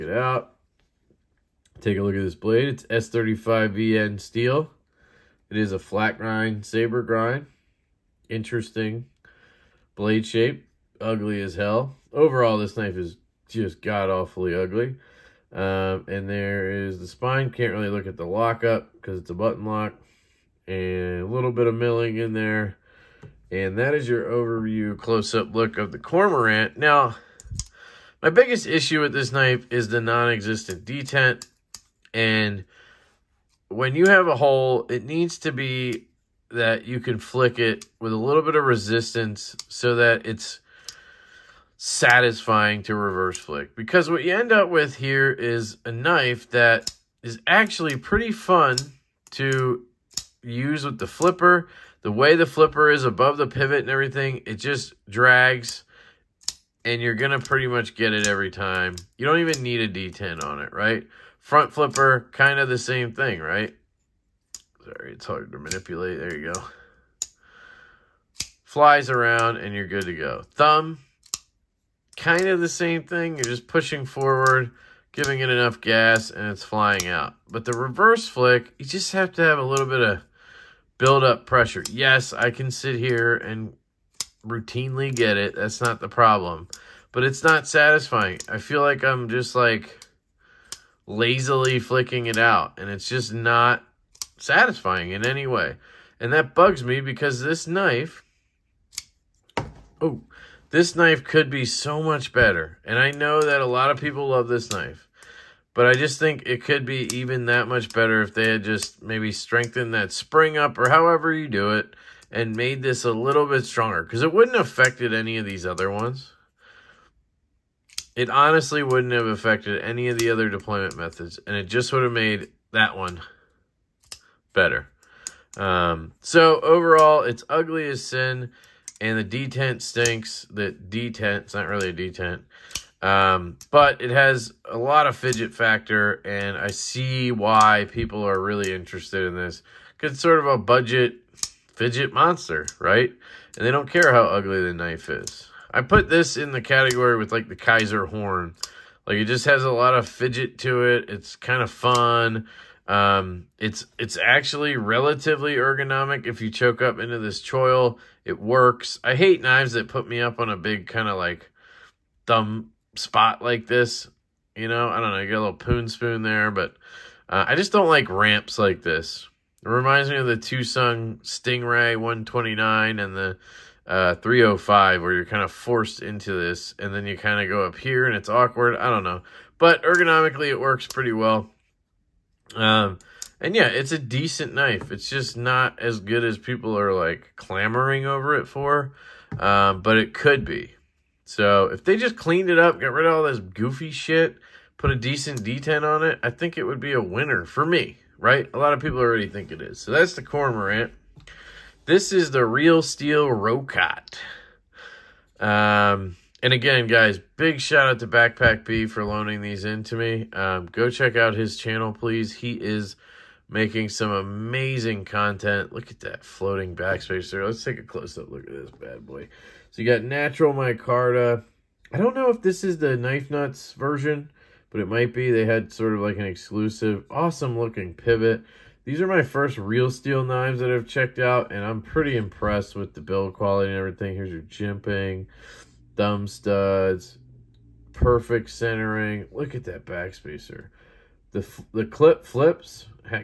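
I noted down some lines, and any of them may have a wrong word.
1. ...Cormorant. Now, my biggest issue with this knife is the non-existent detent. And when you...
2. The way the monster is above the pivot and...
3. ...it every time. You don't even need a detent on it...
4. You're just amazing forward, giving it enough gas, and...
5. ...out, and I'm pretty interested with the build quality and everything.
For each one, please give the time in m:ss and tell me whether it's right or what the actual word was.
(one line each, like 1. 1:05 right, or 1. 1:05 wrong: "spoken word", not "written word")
1. 0:25 right
2. 0:52 wrong: "flipper", not "monster"
3. 0:58 right
4. 1:13 wrong: "pushing", not "amazing"
5. 3:51 wrong: "impressed", not "interested".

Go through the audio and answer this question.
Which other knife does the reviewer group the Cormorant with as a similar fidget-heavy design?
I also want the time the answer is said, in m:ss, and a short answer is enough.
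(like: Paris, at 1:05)
Kizer horn, at 2:27.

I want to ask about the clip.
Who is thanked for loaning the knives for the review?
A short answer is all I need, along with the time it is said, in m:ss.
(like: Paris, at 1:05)
Backpack B, at 3:28.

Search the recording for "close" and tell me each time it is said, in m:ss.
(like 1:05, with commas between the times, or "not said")
0:24, 3:37.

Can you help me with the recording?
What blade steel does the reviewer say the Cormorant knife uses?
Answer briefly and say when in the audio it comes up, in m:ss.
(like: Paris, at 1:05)
S35VN, at 0:02.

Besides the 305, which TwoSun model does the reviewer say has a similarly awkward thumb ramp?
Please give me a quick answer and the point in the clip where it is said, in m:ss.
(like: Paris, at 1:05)
Stingray 129, at 2:51.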